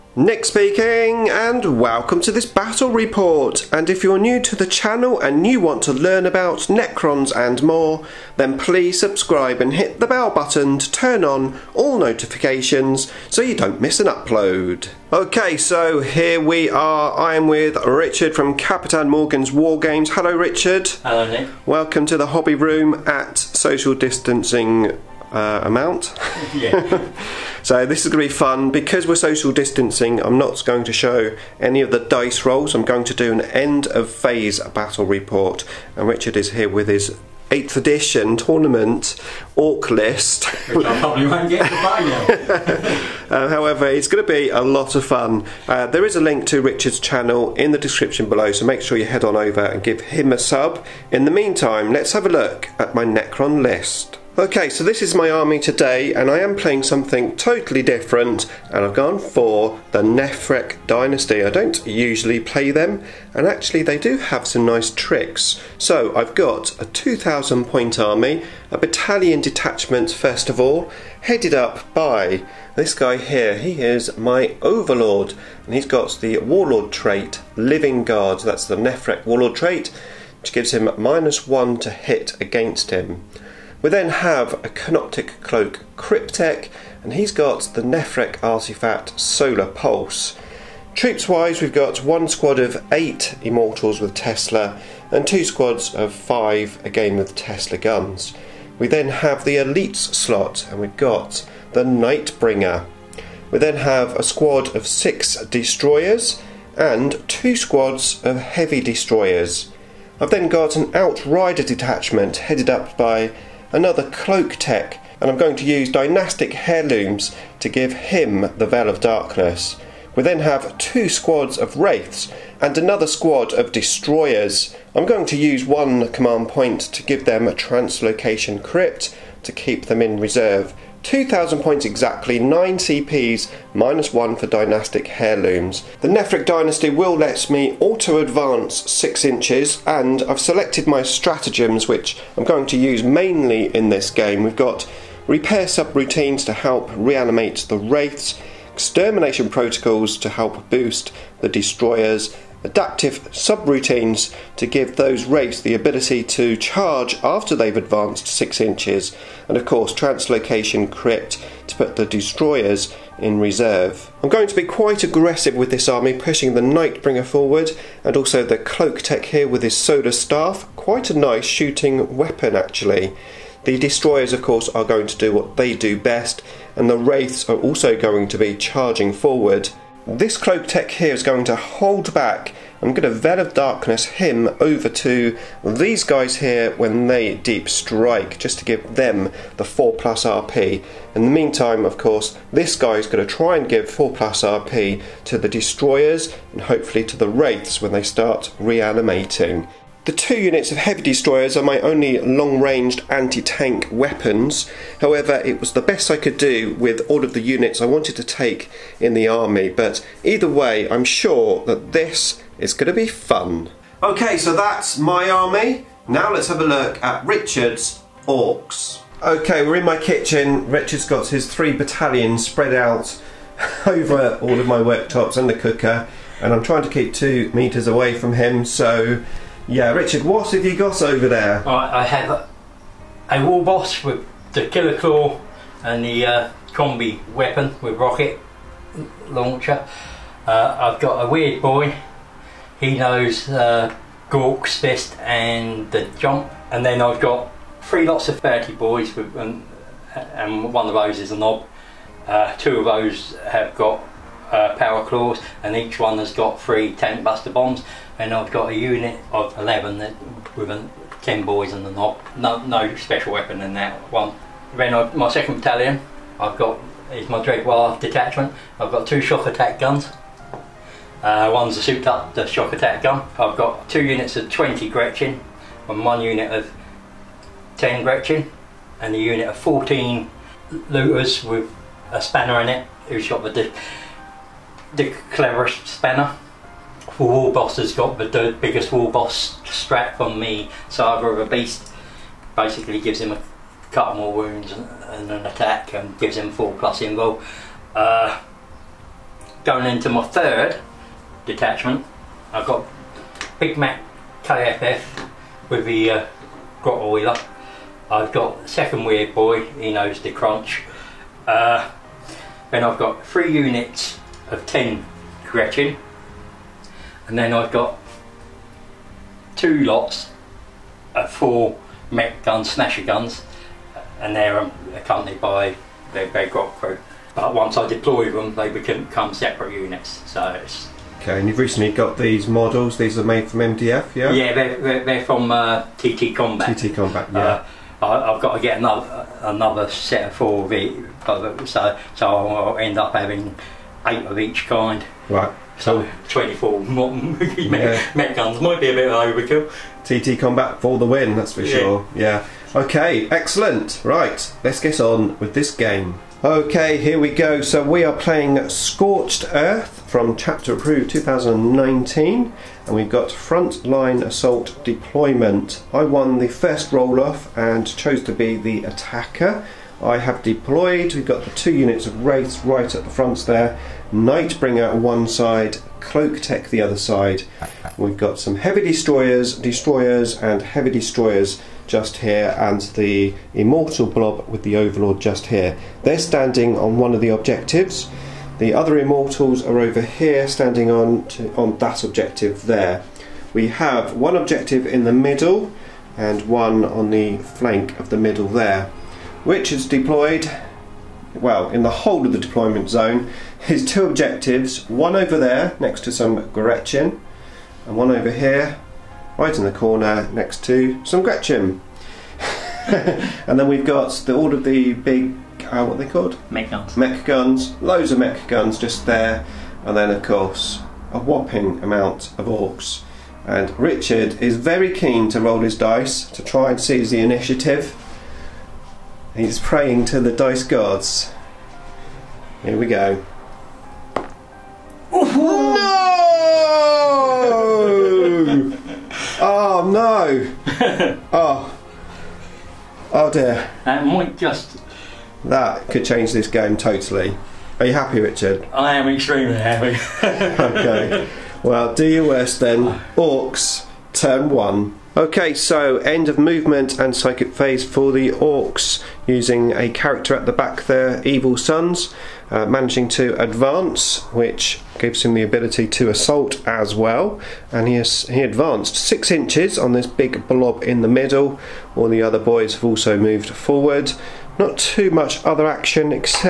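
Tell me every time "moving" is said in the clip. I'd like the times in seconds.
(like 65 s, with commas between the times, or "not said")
not said.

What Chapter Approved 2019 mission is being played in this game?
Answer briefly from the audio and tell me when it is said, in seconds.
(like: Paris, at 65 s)
Scorched Earth, at 358 s.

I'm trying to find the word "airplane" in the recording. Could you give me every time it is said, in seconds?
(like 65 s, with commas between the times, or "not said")
not said.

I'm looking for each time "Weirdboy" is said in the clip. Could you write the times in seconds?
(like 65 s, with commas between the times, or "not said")
241 s, 309 s.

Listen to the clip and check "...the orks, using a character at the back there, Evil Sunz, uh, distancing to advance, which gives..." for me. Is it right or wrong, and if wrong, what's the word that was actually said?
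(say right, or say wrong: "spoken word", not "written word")
wrong: "managing", not "distancing".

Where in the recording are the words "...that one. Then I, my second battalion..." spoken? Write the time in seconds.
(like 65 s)
263 s.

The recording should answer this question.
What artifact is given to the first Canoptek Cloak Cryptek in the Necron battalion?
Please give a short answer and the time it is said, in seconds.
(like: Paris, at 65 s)
Solar Pulse, at 89 s.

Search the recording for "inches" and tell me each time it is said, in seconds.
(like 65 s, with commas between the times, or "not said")
139 s, 158 s, 469 s.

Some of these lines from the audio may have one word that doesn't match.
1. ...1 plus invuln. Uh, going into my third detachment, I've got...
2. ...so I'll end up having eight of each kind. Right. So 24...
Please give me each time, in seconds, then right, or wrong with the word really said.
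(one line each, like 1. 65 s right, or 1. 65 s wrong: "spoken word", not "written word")
1. 296 s wrong: "4", not "1"
2. 342 s right.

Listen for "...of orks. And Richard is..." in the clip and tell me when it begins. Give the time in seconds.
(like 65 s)
422 s.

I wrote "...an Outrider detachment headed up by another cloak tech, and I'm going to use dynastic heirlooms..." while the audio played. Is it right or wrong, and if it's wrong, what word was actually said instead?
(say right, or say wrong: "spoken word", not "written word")
right.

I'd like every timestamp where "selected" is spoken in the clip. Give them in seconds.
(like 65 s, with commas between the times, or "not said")
140 s.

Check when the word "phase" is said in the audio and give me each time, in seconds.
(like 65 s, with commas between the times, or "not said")
34 s, 457 s.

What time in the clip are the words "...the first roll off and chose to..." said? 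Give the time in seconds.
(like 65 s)
366 s.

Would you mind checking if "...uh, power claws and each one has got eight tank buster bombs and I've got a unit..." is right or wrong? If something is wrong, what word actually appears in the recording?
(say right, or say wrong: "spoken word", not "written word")
wrong: "three", not "eight".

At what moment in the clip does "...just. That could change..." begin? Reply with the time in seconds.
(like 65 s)
444 s.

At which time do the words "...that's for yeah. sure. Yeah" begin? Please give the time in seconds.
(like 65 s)
351 s.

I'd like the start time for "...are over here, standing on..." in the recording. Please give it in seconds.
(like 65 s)
389 s.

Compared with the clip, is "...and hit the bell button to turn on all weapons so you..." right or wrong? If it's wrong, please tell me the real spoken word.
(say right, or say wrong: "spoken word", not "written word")
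wrong: "notifications", not "weapons".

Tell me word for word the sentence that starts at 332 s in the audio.
These are made from MDF, yeah?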